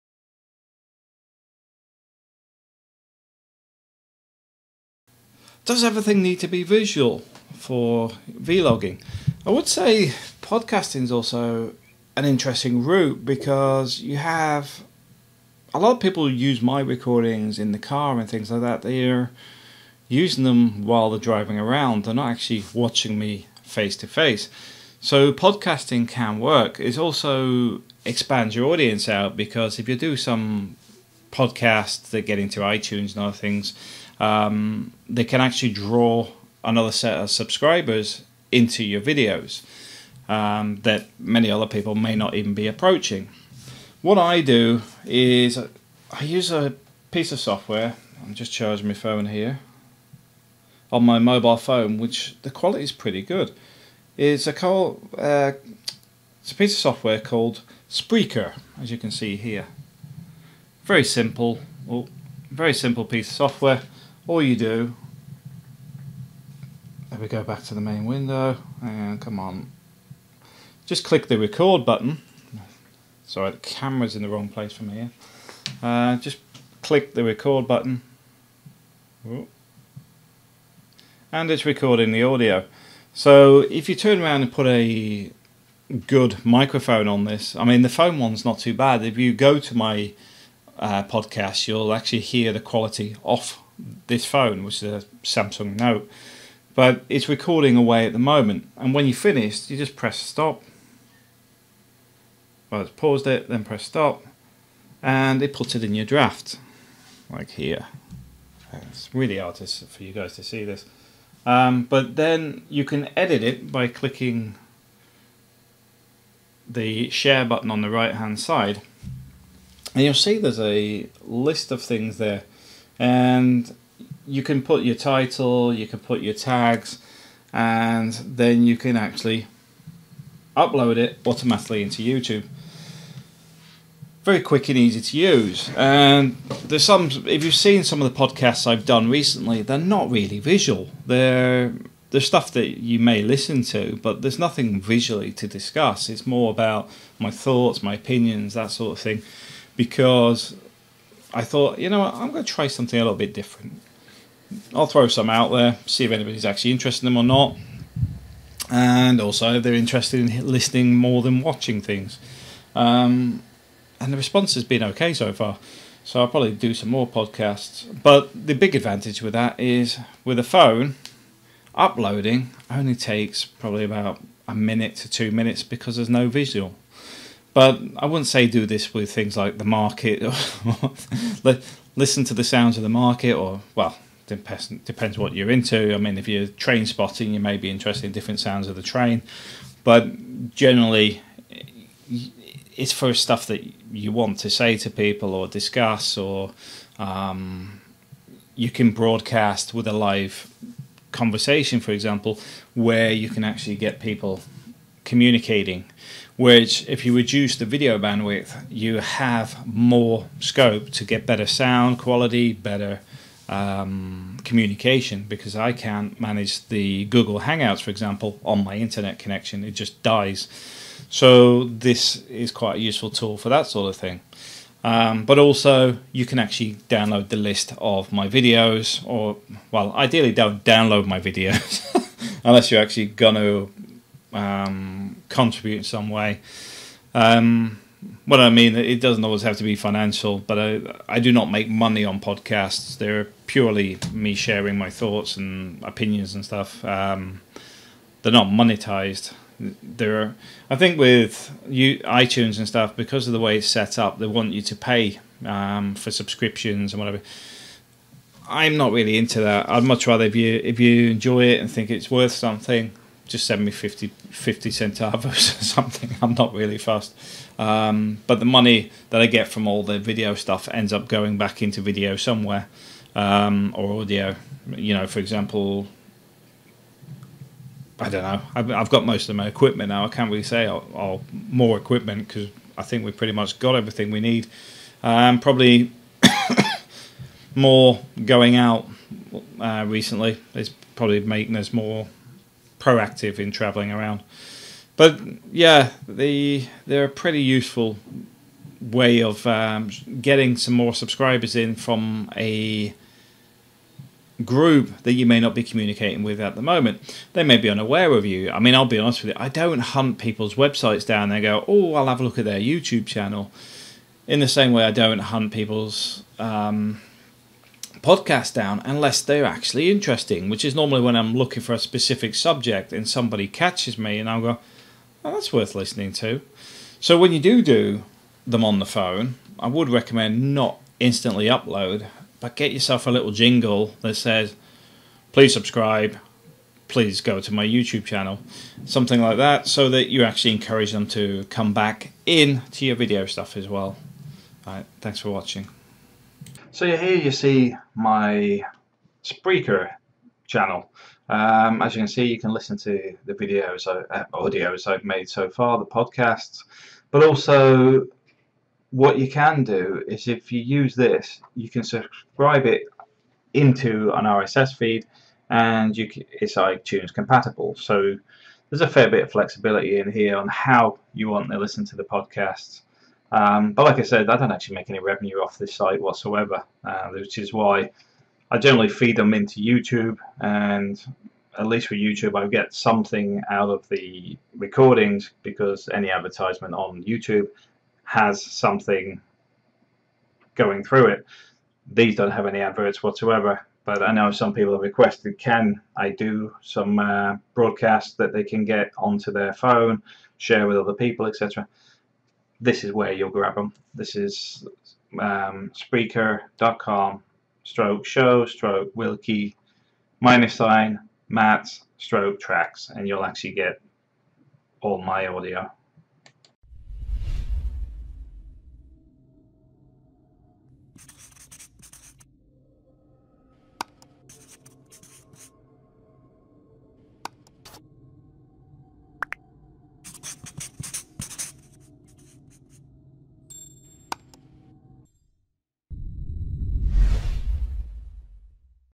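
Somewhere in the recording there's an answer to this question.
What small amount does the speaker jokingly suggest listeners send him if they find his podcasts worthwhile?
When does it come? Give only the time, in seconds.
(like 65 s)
264 s.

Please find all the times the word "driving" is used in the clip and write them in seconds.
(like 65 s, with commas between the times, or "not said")
21 s.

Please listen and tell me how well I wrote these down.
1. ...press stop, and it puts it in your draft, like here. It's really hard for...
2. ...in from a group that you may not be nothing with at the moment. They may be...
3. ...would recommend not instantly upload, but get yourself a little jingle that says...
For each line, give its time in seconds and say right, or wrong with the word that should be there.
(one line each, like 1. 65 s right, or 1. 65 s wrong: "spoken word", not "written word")
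1. 103 s right
2. 301 s wrong: "communicating", not "nothing"
3. 329 s right.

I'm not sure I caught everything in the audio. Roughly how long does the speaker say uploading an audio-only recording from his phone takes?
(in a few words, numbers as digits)
1 to 2 minutes.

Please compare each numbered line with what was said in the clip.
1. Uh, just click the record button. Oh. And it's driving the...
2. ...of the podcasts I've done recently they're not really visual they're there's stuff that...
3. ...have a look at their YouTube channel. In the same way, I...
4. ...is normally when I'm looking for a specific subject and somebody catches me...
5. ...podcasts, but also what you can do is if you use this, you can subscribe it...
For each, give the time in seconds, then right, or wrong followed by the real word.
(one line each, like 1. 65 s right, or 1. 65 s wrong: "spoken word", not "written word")
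1. 75 s wrong: "recording", not "driving"
2. 138 s right
3. 312 s right
4. 320 s right
5. 355 s right.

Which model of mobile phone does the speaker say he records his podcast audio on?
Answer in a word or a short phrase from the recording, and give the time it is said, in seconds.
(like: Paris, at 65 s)
Samsung Note, at 95 s.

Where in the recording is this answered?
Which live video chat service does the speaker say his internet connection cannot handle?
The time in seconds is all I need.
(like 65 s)
217 s.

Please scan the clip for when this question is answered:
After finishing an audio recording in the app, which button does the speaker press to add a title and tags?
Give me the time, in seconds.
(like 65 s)
117 s.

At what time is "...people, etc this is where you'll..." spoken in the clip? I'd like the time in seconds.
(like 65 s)
400 s.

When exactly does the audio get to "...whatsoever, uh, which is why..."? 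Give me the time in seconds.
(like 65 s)
376 s.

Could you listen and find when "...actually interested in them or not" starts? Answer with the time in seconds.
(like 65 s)
156 s.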